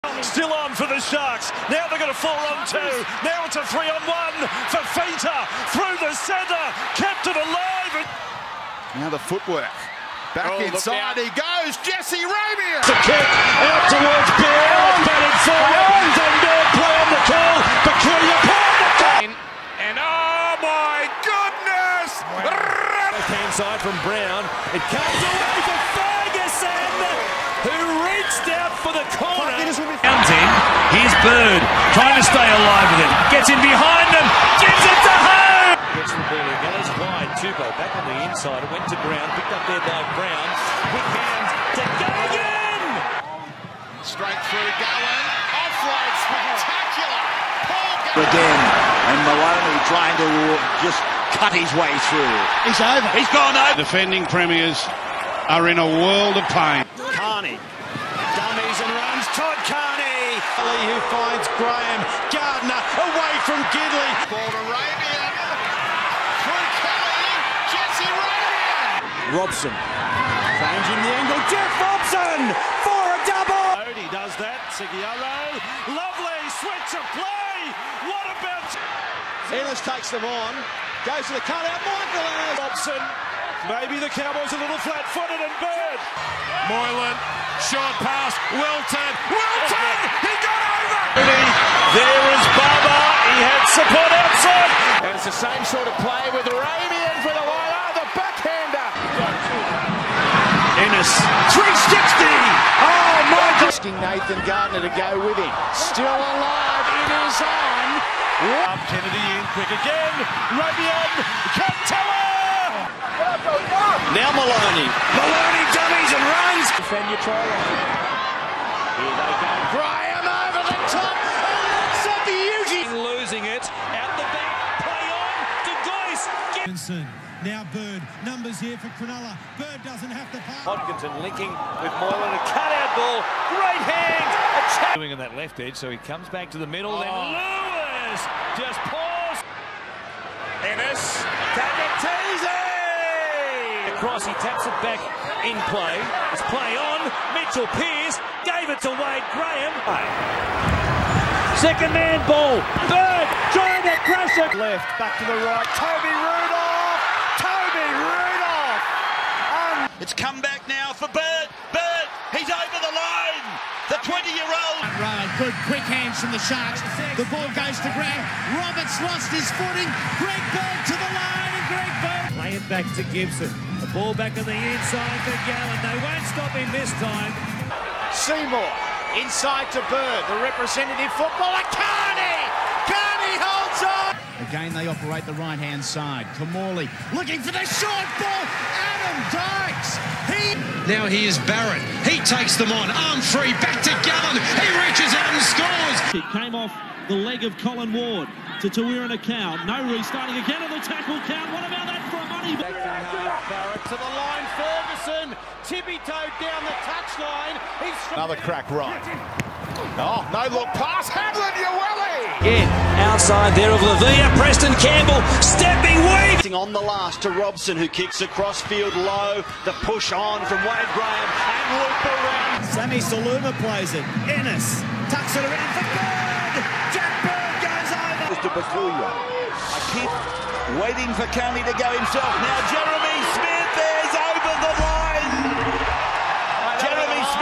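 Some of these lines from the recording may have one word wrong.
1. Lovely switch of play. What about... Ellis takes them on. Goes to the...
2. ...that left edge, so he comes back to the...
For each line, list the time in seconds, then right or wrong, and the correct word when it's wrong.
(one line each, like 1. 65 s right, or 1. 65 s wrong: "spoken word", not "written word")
1. 75 s right
2. 135 s right.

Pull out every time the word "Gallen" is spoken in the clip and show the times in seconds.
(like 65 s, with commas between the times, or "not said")
175 s, 194 s.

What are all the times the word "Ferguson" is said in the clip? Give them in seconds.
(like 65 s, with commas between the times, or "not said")
25 s, 204 s.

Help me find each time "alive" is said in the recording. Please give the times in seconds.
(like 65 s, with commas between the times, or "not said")
7 s, 32 s, 106 s.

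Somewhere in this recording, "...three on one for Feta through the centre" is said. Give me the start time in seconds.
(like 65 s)
3 s.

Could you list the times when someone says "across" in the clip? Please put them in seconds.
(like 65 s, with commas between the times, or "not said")
143 s, 218 s.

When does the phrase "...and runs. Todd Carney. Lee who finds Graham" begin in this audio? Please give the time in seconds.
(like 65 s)
58 s.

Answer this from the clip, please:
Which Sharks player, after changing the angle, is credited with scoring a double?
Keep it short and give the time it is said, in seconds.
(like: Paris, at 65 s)
Jeff Robson, at 71 s.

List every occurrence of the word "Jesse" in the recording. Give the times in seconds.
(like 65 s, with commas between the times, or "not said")
11 s, 67 s.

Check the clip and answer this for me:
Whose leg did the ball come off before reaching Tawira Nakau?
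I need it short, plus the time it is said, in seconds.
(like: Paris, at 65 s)
Colin Ward, at 197 s.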